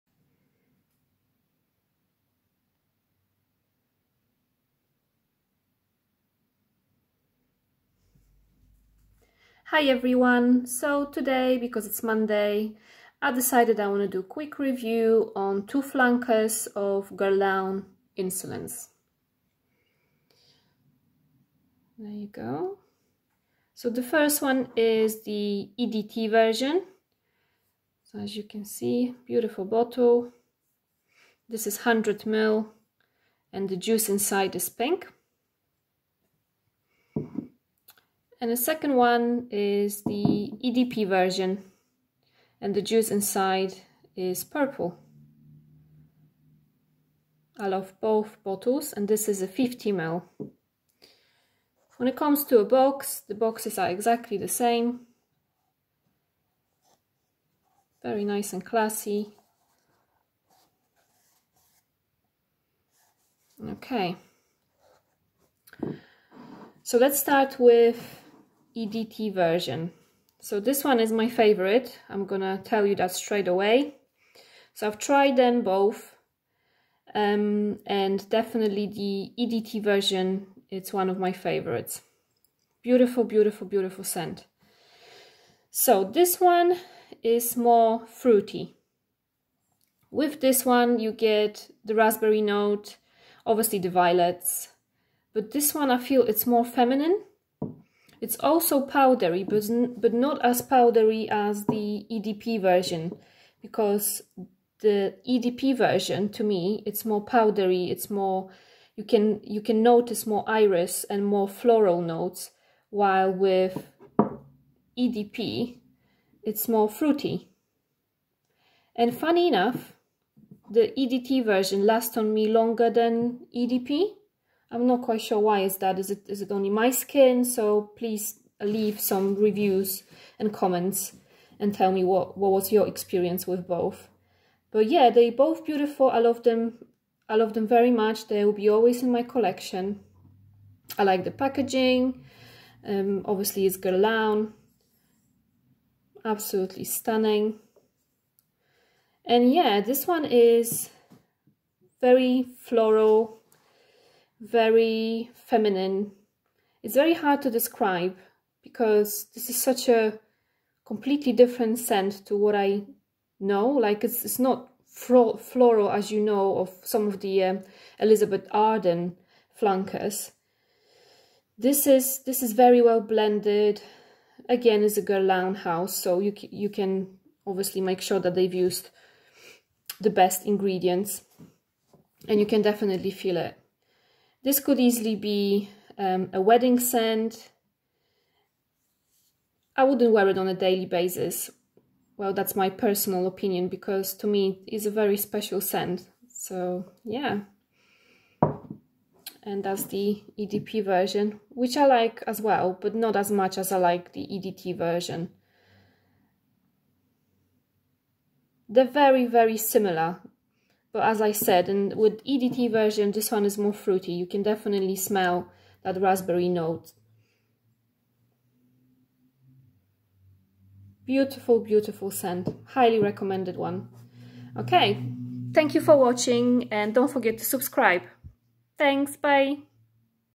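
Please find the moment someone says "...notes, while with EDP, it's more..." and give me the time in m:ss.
1:51.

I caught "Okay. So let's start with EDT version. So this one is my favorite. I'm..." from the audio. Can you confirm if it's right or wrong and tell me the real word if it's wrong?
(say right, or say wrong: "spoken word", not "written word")
right.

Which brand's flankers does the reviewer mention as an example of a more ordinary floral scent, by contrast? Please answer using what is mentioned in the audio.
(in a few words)
Elizabeth Arden.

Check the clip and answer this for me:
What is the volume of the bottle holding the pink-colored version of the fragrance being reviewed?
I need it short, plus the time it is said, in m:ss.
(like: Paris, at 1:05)
100 ml, at 0:31.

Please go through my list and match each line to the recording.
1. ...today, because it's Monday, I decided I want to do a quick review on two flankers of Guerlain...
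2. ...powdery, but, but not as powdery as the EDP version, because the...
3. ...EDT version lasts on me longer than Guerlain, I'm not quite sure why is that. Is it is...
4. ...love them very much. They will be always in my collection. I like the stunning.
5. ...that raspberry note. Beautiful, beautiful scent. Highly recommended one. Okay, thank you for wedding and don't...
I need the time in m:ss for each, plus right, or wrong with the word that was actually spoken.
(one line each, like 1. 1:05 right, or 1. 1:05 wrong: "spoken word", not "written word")
1. 0:11 right
2. 1:38 right
3. 2:00 wrong: "EDP", not "Guerlain"
4. 2:17 wrong: "packaging", not "stunning"
5. 3:35 wrong: "watching", not "wedding".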